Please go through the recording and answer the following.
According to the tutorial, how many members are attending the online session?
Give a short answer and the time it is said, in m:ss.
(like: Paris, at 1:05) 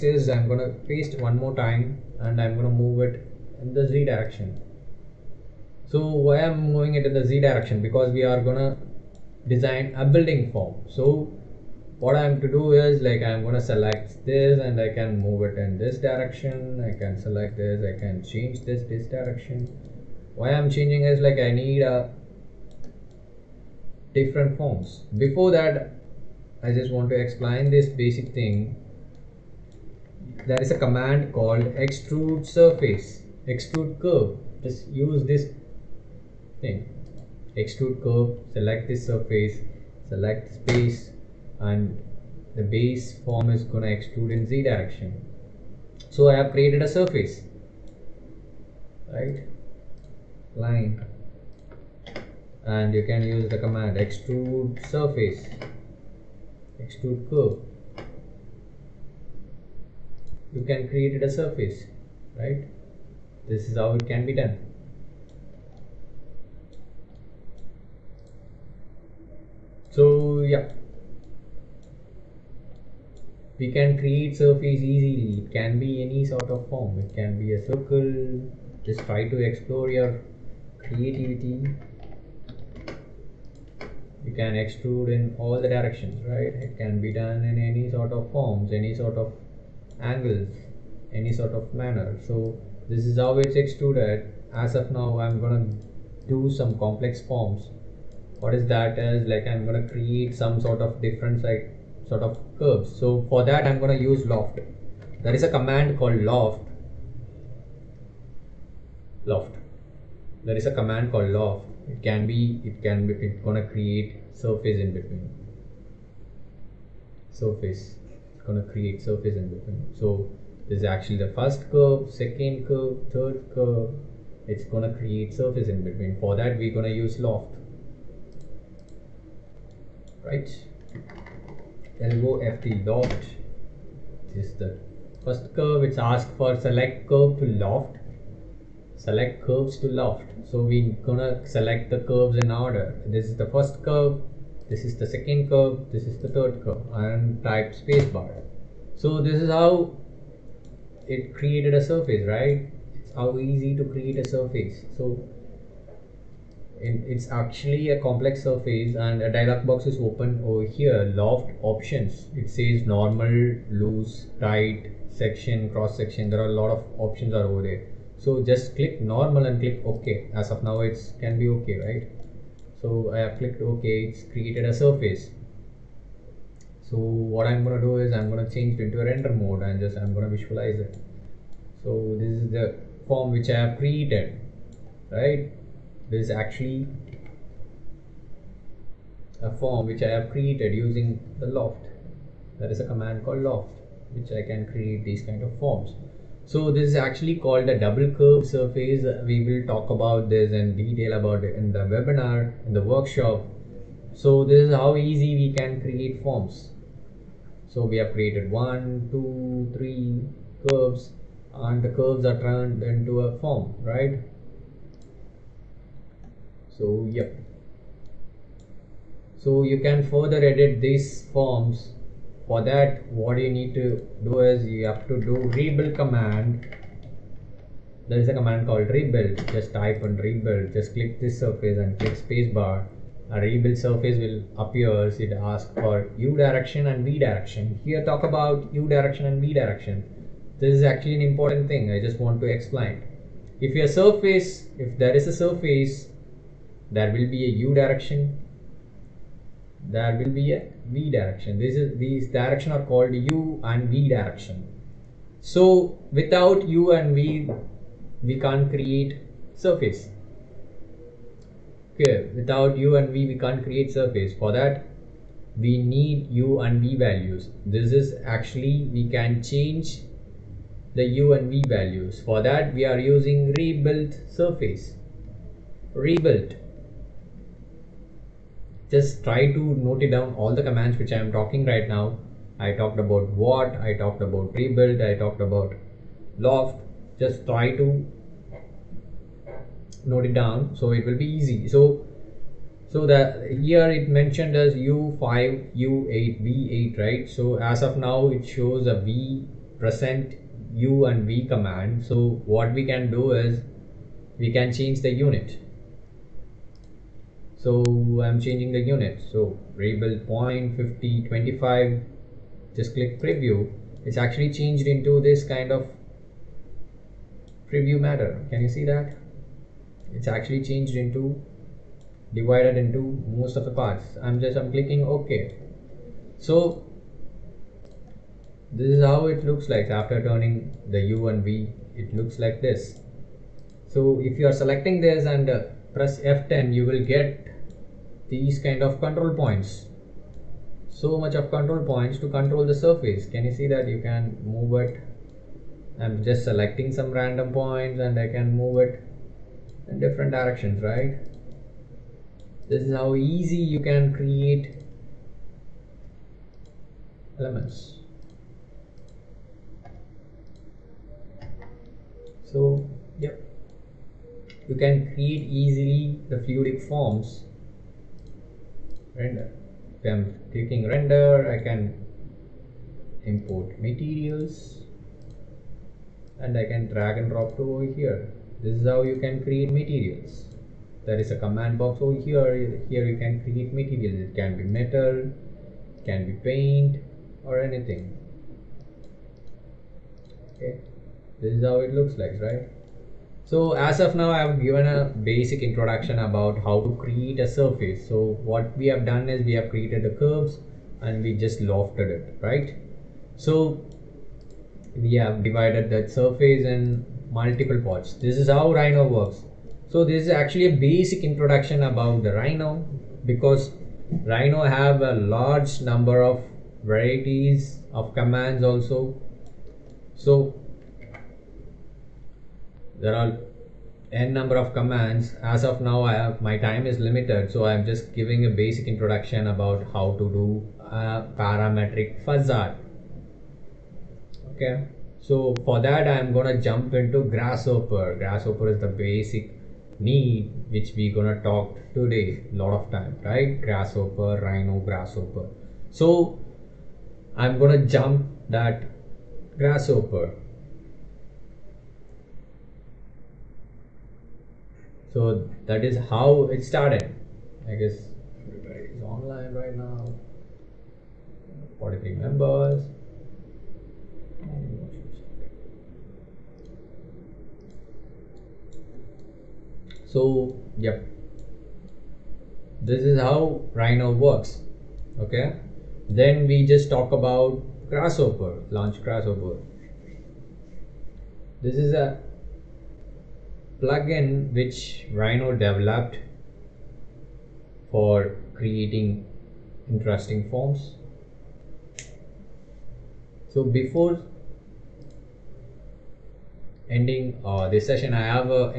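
43, at 7:41.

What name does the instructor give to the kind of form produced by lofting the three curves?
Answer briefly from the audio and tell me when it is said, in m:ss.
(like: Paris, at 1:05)
Double curve surface, at 3:17.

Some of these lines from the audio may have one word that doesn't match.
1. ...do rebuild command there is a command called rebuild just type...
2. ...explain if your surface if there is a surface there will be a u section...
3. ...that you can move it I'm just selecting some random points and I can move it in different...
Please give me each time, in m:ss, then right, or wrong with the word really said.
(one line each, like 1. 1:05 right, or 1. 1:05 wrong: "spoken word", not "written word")
1. 3:45 right
2. 4:02 wrong: "direction", not "section"
3. 5:43 right.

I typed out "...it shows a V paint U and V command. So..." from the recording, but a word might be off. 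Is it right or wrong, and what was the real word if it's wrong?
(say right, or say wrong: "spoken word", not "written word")
wrong: "present", not "paint".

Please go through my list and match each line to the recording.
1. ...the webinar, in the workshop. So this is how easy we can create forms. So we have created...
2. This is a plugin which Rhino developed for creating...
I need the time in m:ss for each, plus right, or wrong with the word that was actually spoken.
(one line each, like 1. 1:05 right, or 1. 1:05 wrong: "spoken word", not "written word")
1. 3:21 right
2. 8:01 right.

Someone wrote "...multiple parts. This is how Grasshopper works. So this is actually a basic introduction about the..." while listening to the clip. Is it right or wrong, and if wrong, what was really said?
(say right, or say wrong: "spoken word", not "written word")
wrong: "Rhino", not "Grasshopper".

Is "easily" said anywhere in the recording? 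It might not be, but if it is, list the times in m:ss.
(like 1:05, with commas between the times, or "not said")
1:14, 6:05.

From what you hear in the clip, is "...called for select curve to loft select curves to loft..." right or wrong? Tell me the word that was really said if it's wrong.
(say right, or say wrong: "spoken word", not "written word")
wrong: "asked", not "called".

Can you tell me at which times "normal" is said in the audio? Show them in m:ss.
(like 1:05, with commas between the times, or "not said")
2:42, 2:49.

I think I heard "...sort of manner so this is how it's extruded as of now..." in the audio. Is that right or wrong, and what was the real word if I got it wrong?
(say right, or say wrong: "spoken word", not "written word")
right.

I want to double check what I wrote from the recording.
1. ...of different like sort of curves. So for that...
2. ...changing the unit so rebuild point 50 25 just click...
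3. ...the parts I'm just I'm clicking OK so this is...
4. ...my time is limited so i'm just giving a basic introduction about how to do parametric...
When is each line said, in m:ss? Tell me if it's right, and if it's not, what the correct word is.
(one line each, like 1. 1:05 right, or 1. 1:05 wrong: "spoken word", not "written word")
1. 1:40 right
2. 5:08 right
3. 5:23 right
4. 7:06 right.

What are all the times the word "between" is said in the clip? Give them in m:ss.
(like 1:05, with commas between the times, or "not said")
1:54, 1:59, 2:05.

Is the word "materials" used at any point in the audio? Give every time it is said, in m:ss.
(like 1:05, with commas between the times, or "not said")
6:13, 6:19, 6:23.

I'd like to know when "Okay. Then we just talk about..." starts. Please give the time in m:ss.
7:55.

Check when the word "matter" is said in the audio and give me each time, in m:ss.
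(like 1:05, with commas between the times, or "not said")
5:17.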